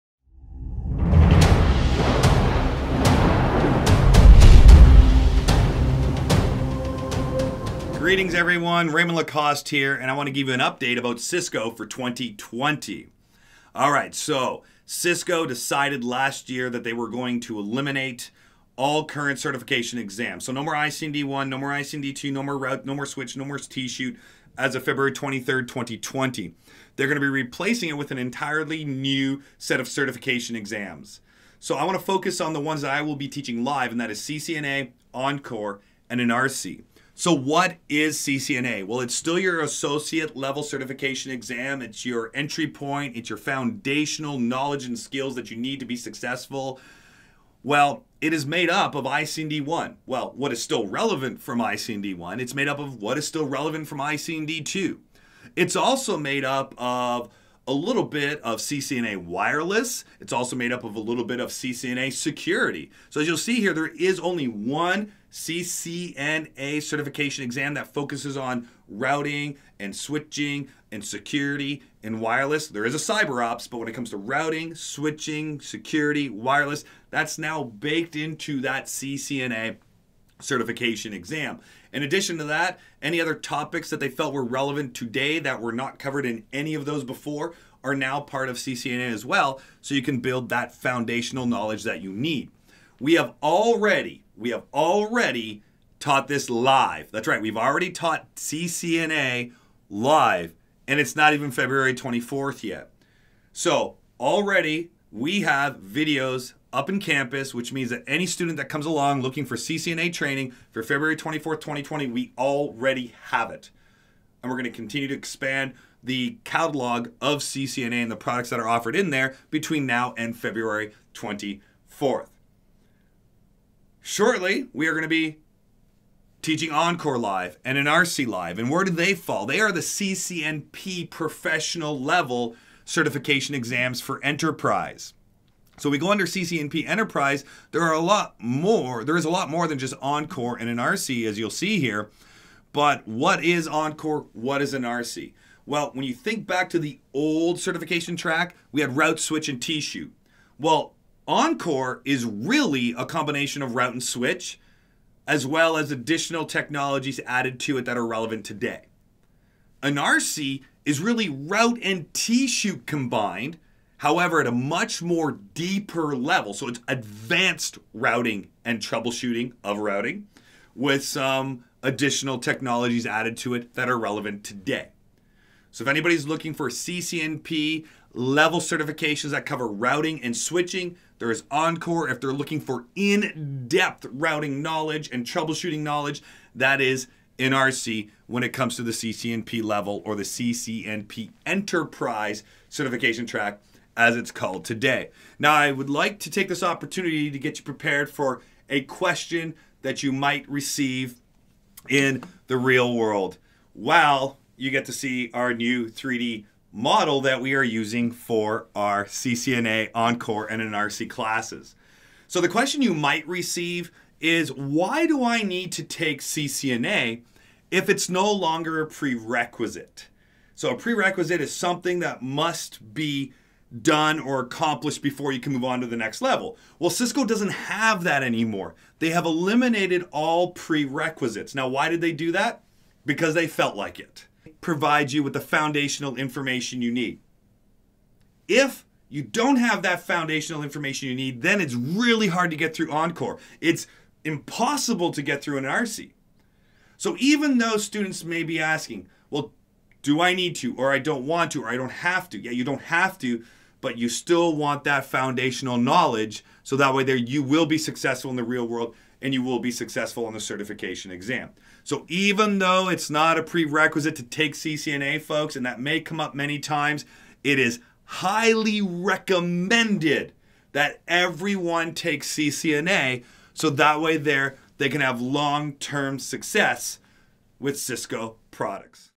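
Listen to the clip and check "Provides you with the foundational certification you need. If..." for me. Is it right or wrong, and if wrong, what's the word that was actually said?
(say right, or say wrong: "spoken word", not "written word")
wrong: "information", not "certification".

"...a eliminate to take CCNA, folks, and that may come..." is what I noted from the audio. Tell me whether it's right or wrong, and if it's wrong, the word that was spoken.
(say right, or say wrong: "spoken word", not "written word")
wrong: "prerequisite", not "eliminate".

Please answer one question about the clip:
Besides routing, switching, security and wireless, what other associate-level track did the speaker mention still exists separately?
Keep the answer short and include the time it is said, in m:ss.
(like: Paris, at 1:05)
Cyber ops, at 1:12.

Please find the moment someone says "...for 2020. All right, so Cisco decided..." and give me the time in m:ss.
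0:11.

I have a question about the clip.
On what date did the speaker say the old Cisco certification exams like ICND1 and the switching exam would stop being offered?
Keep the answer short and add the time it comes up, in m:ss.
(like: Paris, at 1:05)
February 23rd, 2020, at 0:24.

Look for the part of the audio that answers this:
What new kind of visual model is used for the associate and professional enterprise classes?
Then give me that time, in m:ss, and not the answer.
3:25.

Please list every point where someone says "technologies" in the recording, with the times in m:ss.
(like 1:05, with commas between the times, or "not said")
2:36, 2:52.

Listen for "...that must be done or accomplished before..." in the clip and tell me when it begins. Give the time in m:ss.
3:41.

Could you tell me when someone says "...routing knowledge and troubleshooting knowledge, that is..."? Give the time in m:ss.
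3:04.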